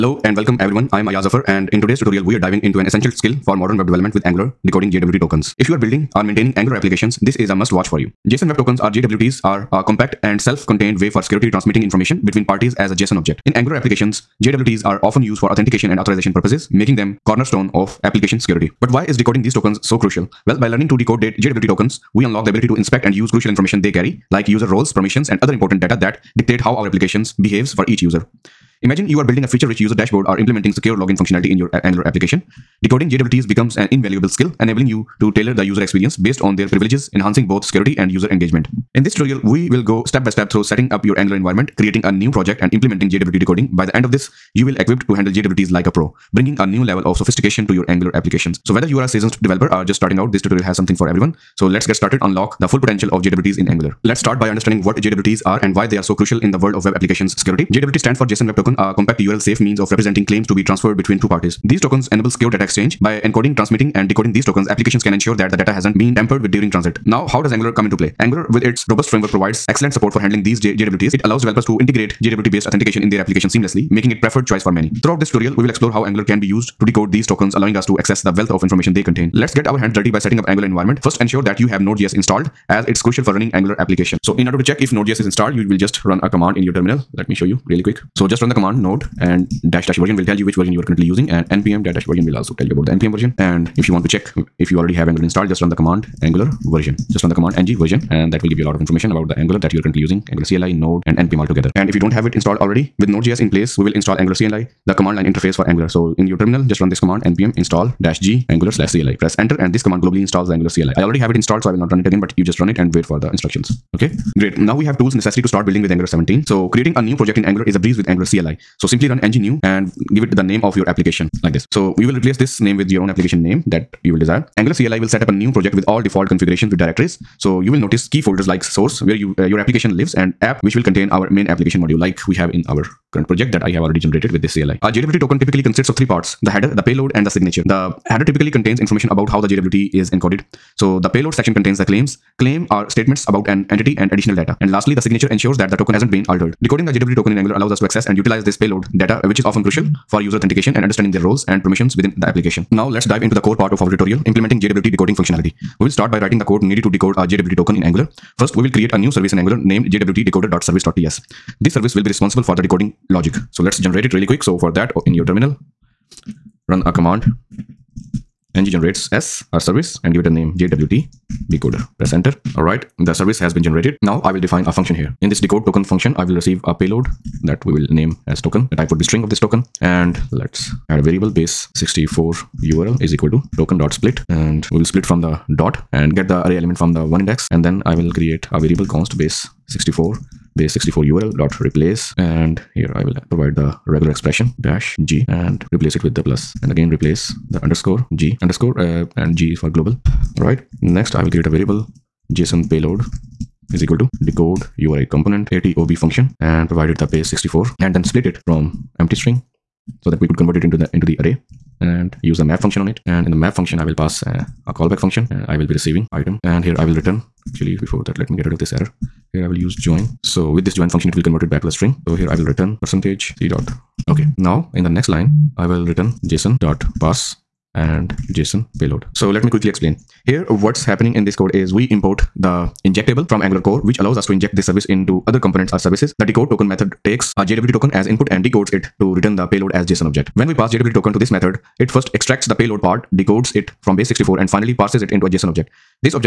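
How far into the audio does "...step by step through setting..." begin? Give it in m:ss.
0:40.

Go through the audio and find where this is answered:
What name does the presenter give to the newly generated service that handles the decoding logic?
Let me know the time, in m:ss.
2:50.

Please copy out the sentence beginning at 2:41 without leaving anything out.
This service will be responsible for the decoding logic.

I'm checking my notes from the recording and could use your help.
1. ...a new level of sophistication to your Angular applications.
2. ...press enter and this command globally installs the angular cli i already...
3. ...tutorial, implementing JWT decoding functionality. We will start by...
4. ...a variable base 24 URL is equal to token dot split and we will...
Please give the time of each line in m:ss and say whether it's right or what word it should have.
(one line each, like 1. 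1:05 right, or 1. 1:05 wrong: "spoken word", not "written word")
1. 0:46 right
2. 1:49 right
3. 2:33 right
4. 3:00 wrong: "64", not "24".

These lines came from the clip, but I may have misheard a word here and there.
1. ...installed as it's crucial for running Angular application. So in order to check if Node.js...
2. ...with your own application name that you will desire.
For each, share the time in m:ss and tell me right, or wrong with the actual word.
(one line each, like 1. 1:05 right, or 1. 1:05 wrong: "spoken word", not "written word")
1. 1:22 right
2. 2:02 right.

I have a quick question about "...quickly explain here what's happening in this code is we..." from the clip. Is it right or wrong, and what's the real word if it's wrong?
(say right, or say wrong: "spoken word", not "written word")
right.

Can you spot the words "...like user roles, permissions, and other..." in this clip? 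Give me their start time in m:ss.
0:24.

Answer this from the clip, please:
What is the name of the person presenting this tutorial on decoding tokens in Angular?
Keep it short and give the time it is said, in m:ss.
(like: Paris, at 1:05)
Ayyaz Zafar, at 0:01.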